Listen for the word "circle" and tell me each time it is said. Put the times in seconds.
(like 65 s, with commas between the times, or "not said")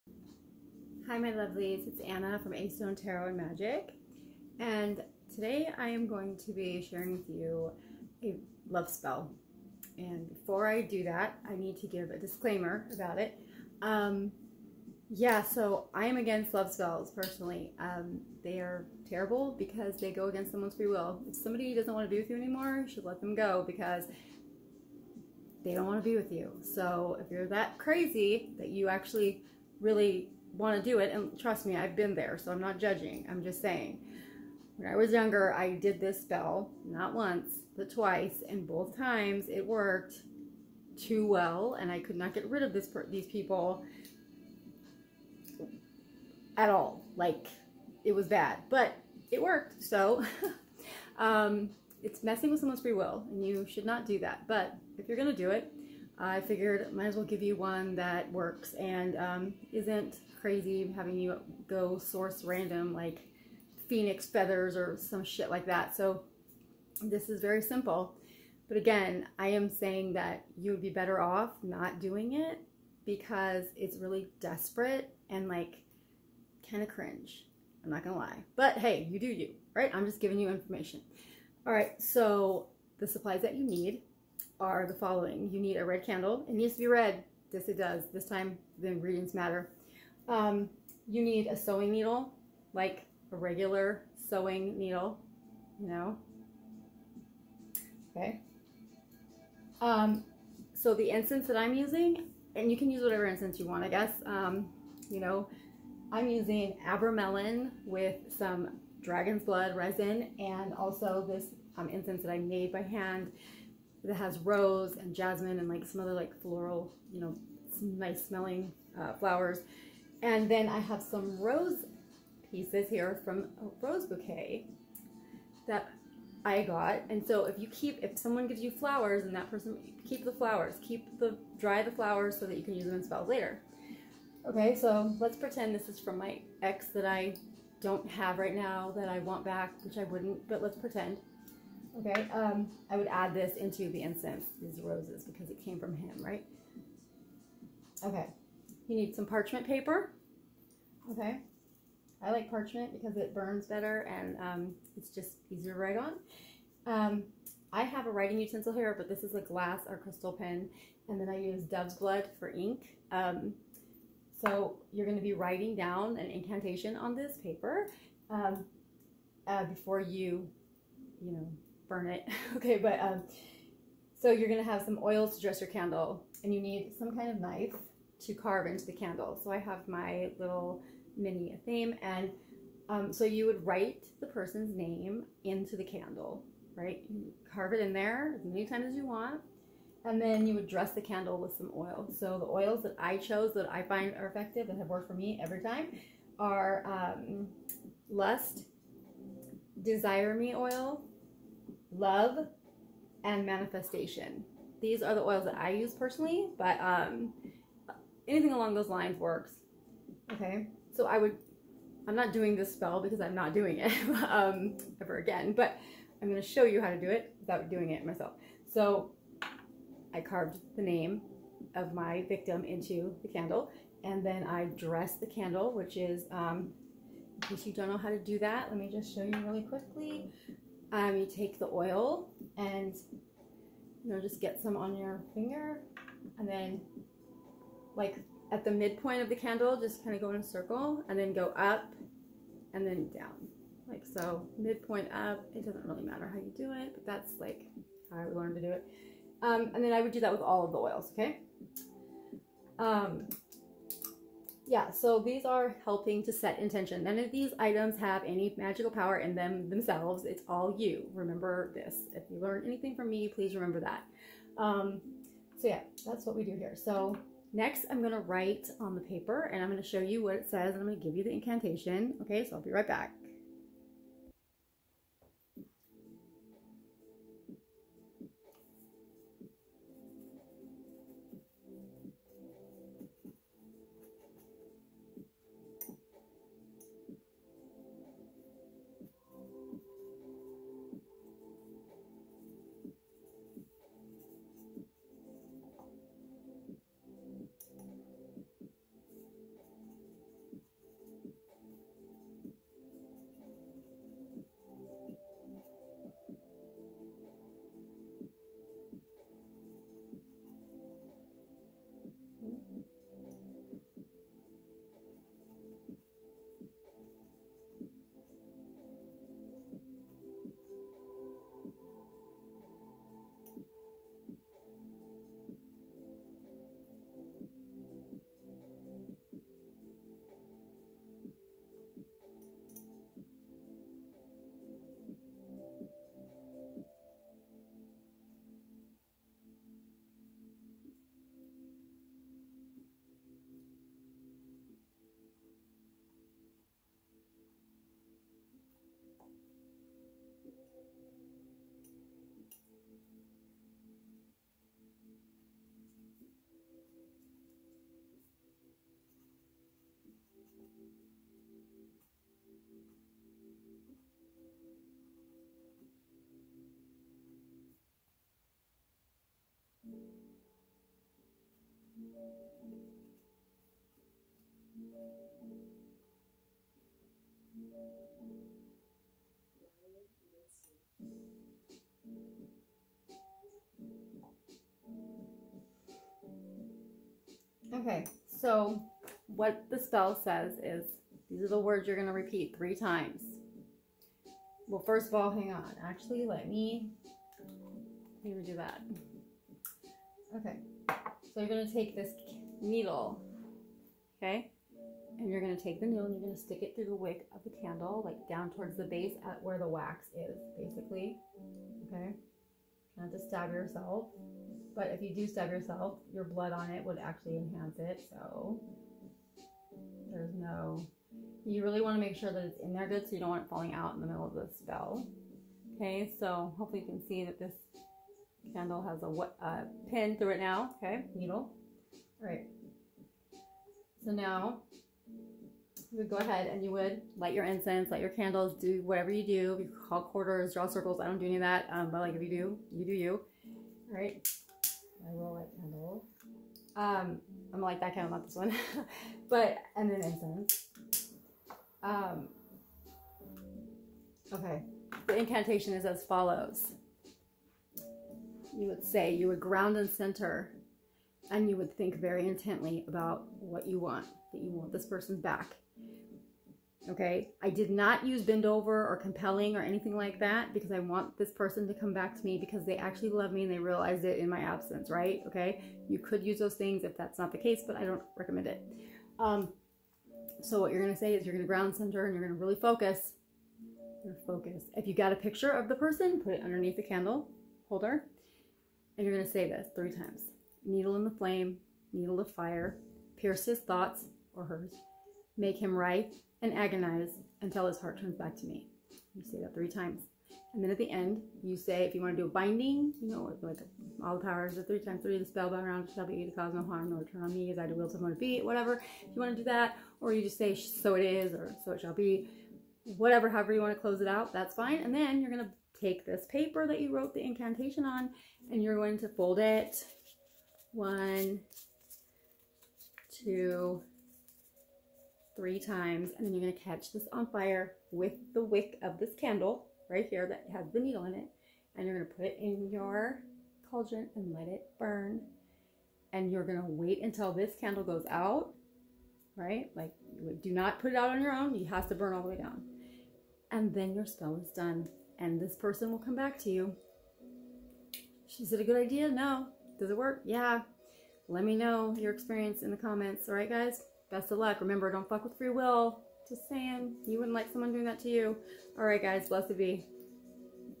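240 s, 440 s.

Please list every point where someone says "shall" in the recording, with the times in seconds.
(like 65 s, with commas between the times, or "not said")
505 s, 511 s.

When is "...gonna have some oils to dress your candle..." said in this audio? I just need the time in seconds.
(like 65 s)
174 s.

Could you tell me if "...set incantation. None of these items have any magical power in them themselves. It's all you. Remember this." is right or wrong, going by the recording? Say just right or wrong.
wrong.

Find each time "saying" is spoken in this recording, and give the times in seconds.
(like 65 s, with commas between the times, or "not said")
33 s, 69 s, 556 s.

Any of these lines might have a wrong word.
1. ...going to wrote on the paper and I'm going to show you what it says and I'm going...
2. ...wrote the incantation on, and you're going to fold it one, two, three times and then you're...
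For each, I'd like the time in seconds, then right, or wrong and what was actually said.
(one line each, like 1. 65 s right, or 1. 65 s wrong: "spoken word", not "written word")
1. 267 s wrong: "write", not "wrote"
2. 516 s right.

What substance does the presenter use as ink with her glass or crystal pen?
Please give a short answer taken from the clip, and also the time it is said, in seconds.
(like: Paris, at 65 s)
dove's blood, at 161 s.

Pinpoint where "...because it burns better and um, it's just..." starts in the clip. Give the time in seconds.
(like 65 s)
152 s.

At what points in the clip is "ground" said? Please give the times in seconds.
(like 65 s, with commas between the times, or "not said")
459 s, 481 s.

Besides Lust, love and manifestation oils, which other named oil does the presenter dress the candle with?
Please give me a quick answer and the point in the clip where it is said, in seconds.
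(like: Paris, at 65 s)
Desire Me Oil, at 199 s.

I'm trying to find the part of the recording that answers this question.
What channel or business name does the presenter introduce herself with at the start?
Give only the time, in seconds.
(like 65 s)
2 s.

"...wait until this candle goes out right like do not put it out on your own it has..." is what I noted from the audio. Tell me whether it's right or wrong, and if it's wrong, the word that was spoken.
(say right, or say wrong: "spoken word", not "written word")
right.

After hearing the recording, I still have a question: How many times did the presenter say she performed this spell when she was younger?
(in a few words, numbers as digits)
twice.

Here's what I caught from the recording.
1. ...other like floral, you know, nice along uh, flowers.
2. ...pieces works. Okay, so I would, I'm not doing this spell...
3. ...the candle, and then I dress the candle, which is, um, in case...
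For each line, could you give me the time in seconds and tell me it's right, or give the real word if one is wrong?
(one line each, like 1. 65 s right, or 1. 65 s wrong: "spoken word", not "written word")
1. 116 s wrong: "smelling", not "along"
2. 208 s wrong: "lines", not "pieces"
3. 223 s right.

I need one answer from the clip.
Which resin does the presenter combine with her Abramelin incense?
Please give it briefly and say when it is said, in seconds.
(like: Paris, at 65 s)
dragon's blood, at 109 s.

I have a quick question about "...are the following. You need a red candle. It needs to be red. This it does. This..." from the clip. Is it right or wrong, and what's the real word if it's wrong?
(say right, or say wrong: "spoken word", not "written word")
right.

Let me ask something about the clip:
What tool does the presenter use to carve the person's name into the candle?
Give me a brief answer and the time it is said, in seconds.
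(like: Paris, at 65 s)
mini athame, at 181 s.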